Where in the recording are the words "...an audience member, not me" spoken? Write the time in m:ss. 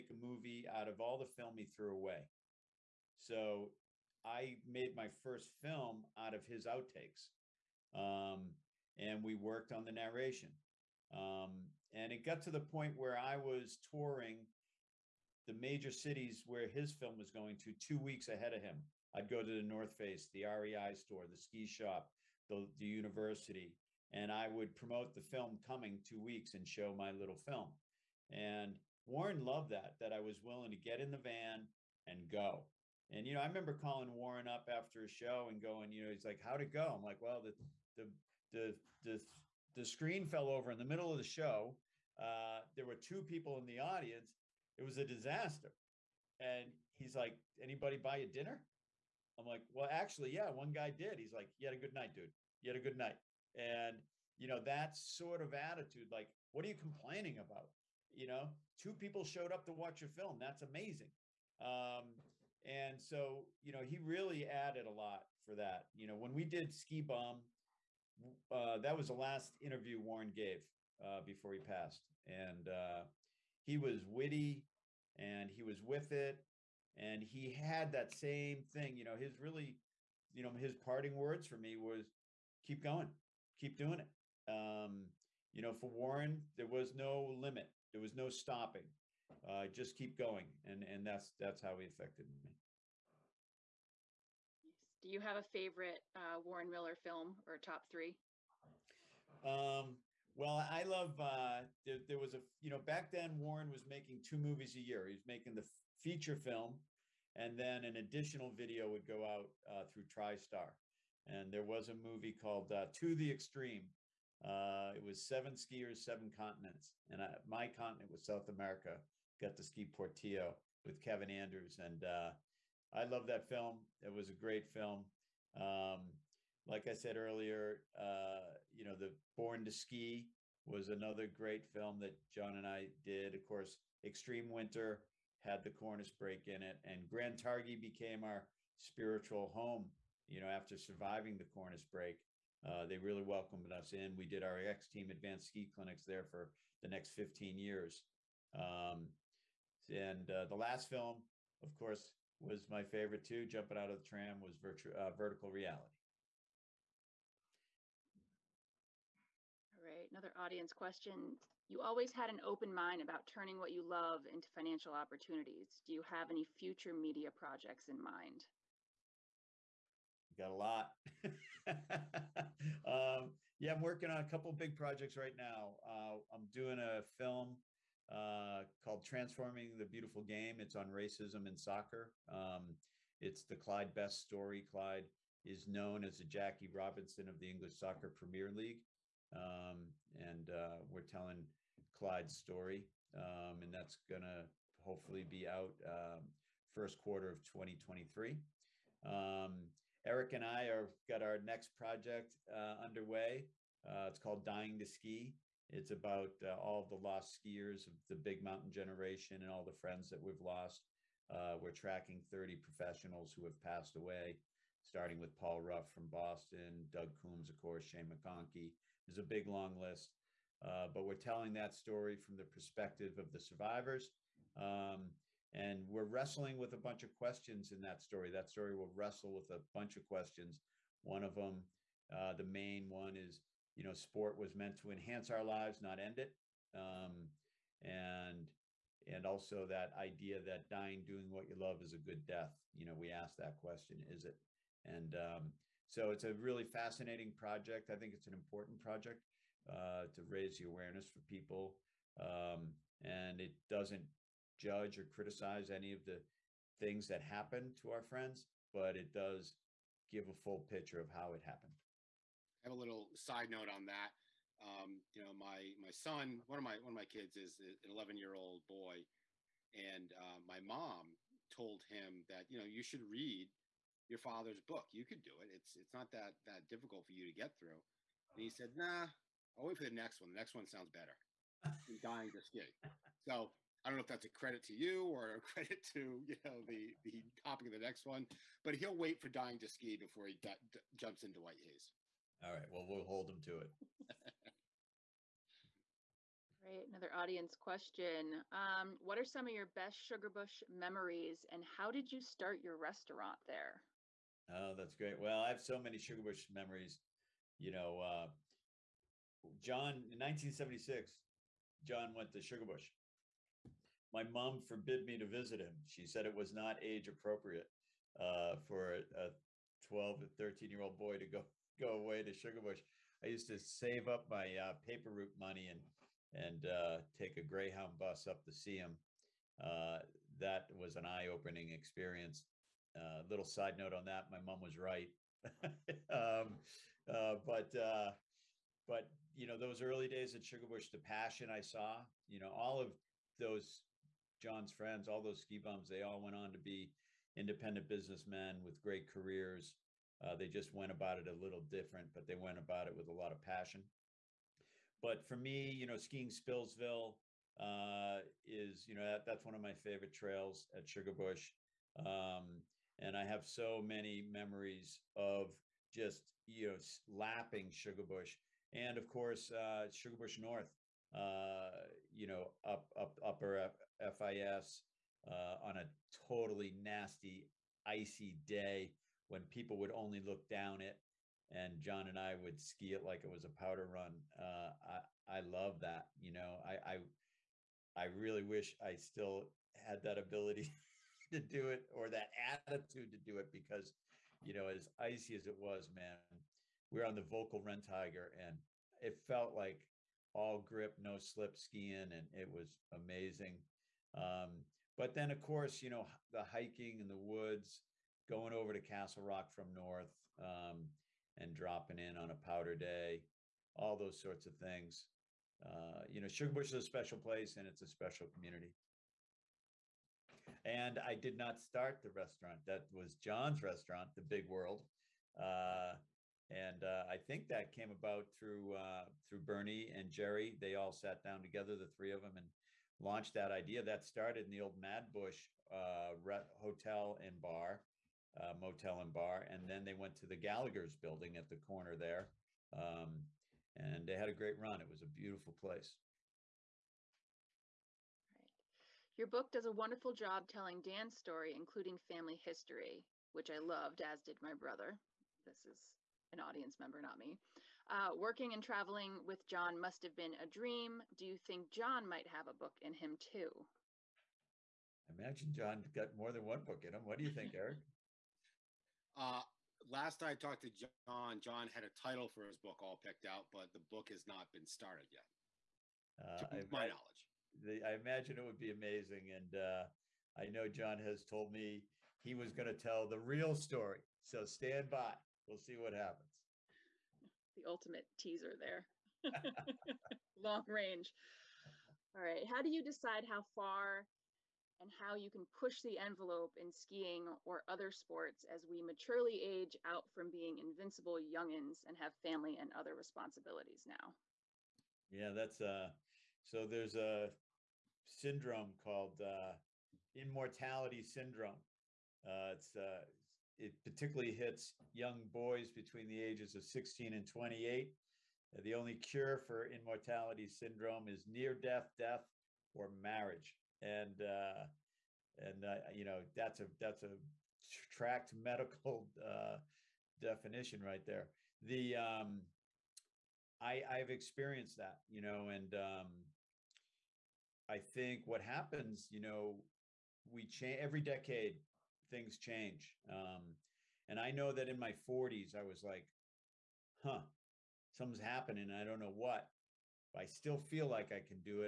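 7:36.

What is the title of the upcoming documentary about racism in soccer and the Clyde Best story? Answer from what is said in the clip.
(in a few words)
Transforming the Beautiful Game.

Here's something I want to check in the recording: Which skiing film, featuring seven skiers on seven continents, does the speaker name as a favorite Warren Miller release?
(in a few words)
To the Extreme.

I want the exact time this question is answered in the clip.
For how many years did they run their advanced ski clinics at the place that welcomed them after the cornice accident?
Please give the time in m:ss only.
2:27.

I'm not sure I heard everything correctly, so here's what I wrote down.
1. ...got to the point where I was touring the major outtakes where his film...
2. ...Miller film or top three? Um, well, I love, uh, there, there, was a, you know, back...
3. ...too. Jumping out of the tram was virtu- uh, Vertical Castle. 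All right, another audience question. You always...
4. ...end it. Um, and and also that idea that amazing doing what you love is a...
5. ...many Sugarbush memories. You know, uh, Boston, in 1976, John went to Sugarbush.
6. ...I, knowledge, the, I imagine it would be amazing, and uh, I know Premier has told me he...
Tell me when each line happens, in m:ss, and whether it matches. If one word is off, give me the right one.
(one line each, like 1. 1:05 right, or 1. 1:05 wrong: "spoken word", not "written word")
1. 0:12 wrong: "cities", not "outtakes"
2. 1:36 right
3. 2:33 wrong: "Reality", not "Castle"
4. 3:55 wrong: "dying", not "amazing"
5. 5:05 wrong: "John", not "Boston"
6. 7:56 wrong: "John", not "Premier".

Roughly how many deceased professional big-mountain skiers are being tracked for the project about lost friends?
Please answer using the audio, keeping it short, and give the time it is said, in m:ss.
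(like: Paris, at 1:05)
30, at 3:32.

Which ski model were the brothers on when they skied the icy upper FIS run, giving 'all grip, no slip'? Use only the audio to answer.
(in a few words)
Völkl Renntiger.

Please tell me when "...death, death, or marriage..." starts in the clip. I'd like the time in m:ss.
8:41.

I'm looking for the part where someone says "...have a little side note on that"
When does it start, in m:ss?
4:22.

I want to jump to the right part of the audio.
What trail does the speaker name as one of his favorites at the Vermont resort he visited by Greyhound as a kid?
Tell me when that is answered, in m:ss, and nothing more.
5:56.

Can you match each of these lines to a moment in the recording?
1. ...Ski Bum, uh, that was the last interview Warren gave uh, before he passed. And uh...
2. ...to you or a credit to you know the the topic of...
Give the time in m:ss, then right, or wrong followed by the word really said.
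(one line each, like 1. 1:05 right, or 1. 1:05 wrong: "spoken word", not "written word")
1. 1:06 right
2. 4:44 right.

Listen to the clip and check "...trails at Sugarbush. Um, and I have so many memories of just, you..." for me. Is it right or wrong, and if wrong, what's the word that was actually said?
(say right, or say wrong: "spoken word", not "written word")
right.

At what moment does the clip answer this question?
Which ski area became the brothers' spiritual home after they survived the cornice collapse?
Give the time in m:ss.
2:17.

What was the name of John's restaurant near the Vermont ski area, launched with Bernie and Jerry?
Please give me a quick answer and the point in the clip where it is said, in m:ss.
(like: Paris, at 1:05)
The Big World, at 7:04.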